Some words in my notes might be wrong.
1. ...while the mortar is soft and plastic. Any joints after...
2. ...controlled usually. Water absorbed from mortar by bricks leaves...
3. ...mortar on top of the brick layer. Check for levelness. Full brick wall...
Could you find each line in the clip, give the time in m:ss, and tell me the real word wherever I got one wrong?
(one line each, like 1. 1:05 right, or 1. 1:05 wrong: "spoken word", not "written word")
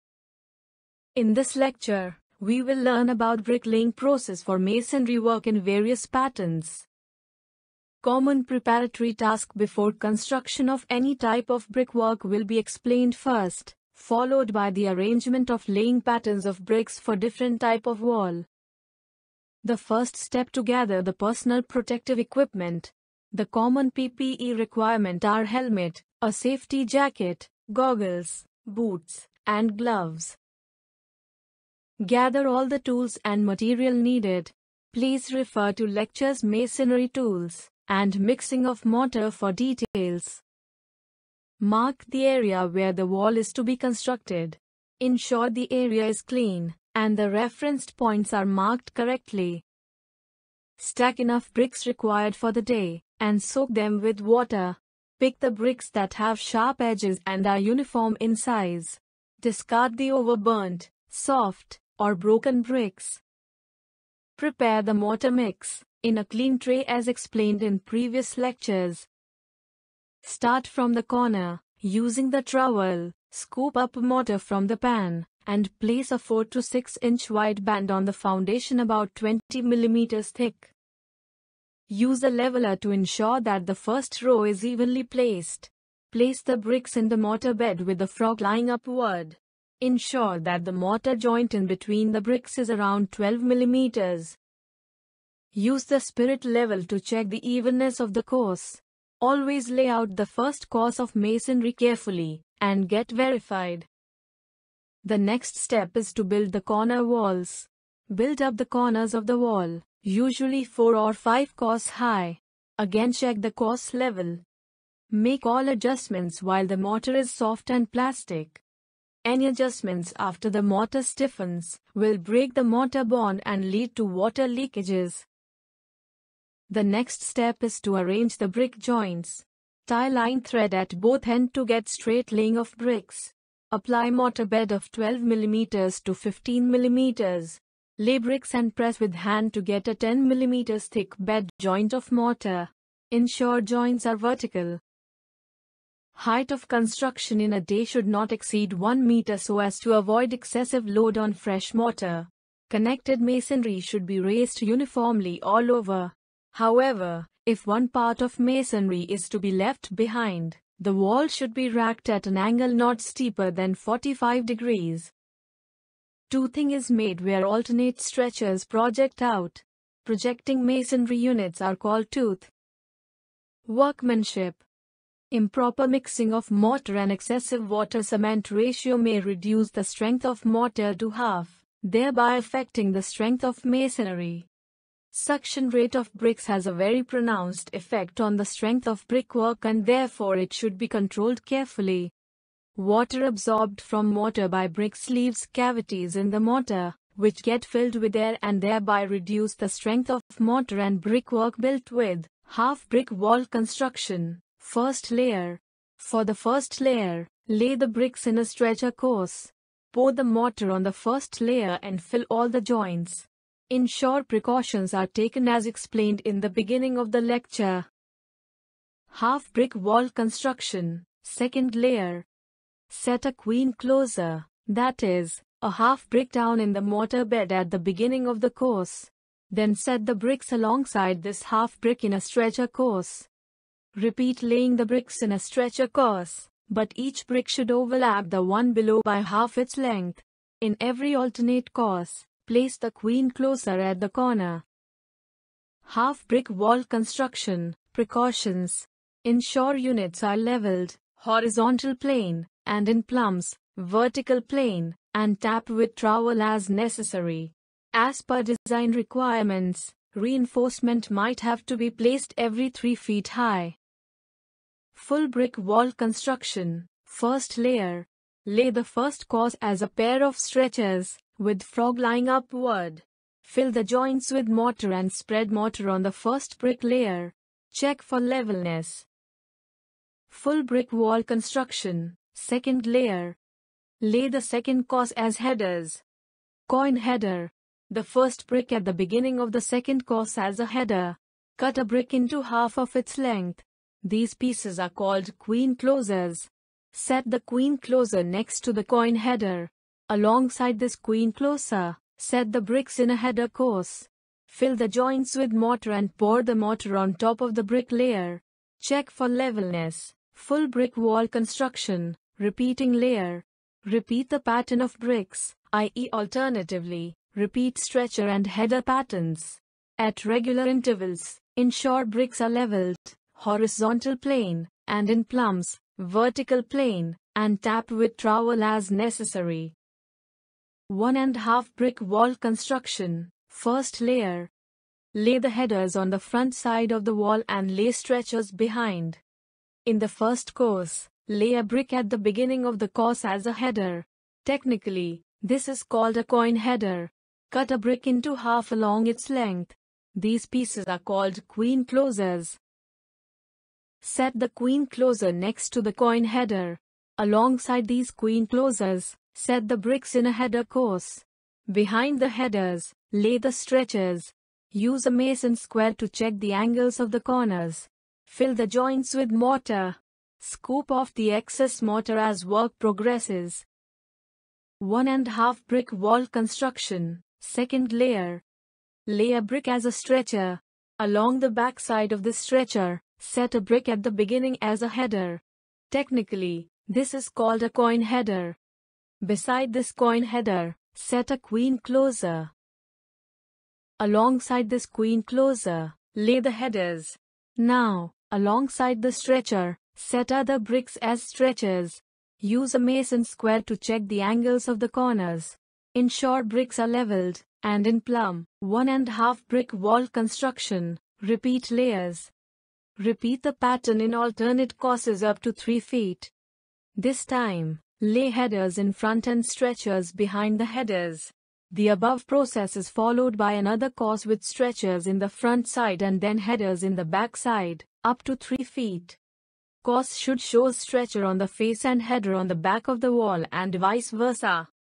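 1. 1:56 wrong: "adjustments", not "joints"
2. 3:10 wrong: "carefully", not "usually"
3. 5:06 right.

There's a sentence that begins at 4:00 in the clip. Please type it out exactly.
In every alternate course, place the queen closer at the corner.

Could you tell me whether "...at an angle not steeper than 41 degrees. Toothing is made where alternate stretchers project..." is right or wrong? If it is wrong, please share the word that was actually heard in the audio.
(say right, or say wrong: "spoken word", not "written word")
wrong: "45", not "41".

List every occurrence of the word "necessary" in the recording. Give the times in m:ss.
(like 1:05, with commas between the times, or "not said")
4:16, 5:28.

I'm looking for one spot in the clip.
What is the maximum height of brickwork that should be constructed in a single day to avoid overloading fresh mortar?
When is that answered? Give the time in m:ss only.
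2:28.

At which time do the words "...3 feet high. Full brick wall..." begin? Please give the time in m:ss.
4:22.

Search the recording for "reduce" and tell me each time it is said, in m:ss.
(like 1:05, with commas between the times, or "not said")
2:59, 3:19.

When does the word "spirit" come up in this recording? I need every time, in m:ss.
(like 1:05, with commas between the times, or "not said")
1:35.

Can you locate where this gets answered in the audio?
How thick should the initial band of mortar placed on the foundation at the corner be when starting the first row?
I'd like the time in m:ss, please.
1:19.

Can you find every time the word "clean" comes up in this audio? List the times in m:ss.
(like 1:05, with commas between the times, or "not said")
0:46, 1:06.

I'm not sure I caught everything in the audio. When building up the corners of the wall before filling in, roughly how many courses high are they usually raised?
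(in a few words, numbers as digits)
4 or 5.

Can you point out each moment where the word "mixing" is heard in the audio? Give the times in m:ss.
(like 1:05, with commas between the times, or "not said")
0:38, 2:55.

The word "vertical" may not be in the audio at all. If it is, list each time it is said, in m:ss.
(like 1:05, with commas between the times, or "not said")
2:24, 4:13, 5:25.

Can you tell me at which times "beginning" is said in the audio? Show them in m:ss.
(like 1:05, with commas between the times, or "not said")
3:36, 3:47, 4:48, 5:42, 6:24.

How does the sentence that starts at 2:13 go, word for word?
Apply mortar bed of 12 mm to 15 mm.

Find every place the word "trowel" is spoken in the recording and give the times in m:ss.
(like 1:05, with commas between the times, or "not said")
1:12, 4:15, 5:28.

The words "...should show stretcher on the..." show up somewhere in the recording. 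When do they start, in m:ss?
7:10.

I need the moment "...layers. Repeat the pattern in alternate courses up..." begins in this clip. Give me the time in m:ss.
6:51.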